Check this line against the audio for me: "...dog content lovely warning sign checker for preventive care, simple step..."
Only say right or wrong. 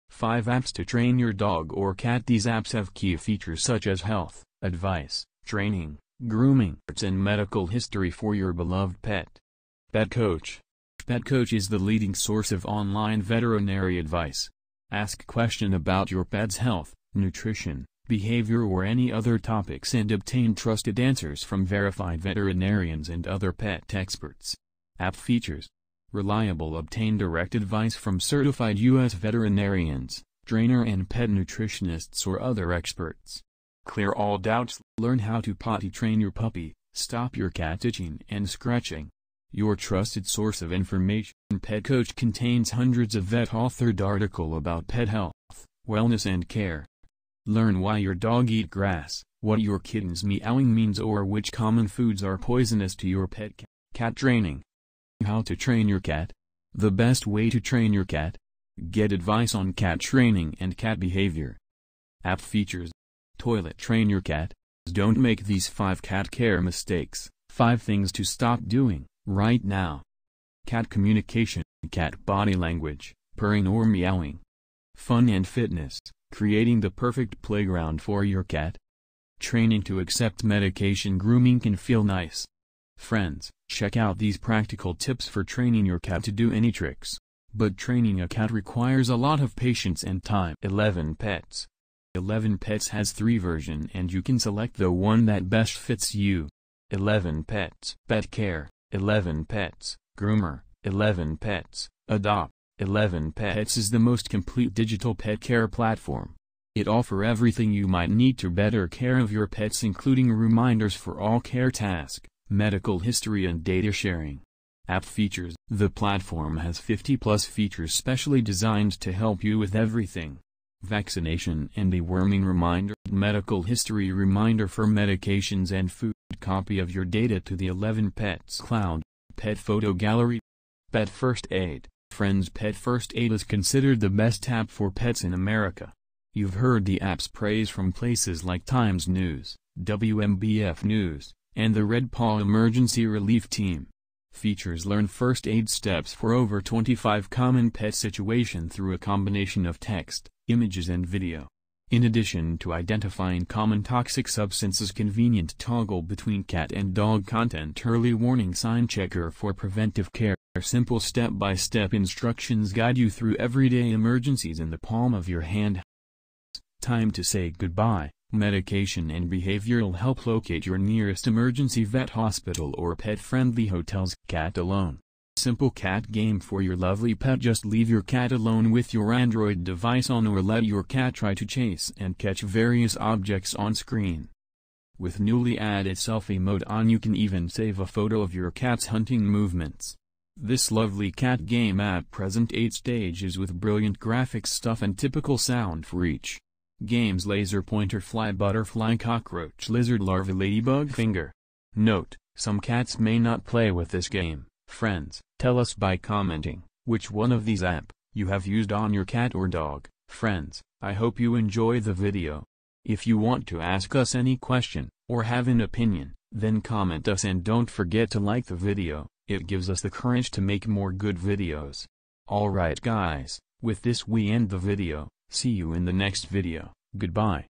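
wrong.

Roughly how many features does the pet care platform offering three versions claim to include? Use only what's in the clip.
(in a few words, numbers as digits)
50 plus.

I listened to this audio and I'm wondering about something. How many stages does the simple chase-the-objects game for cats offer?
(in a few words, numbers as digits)
8.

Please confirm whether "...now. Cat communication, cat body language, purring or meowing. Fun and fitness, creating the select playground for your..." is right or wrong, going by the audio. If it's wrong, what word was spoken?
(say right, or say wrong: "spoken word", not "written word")
wrong: "perfect", not "select".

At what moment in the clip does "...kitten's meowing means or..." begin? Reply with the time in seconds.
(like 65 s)
49 s.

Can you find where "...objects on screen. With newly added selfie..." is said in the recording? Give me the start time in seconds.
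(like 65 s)
183 s.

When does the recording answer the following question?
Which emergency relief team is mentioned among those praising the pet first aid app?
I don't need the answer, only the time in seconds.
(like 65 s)
141 s.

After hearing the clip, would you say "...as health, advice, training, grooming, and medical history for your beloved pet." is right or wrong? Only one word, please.
right.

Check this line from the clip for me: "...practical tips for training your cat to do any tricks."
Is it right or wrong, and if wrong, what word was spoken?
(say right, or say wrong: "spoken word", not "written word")
right.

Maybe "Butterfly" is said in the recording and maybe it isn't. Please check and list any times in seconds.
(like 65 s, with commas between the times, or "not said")
198 s.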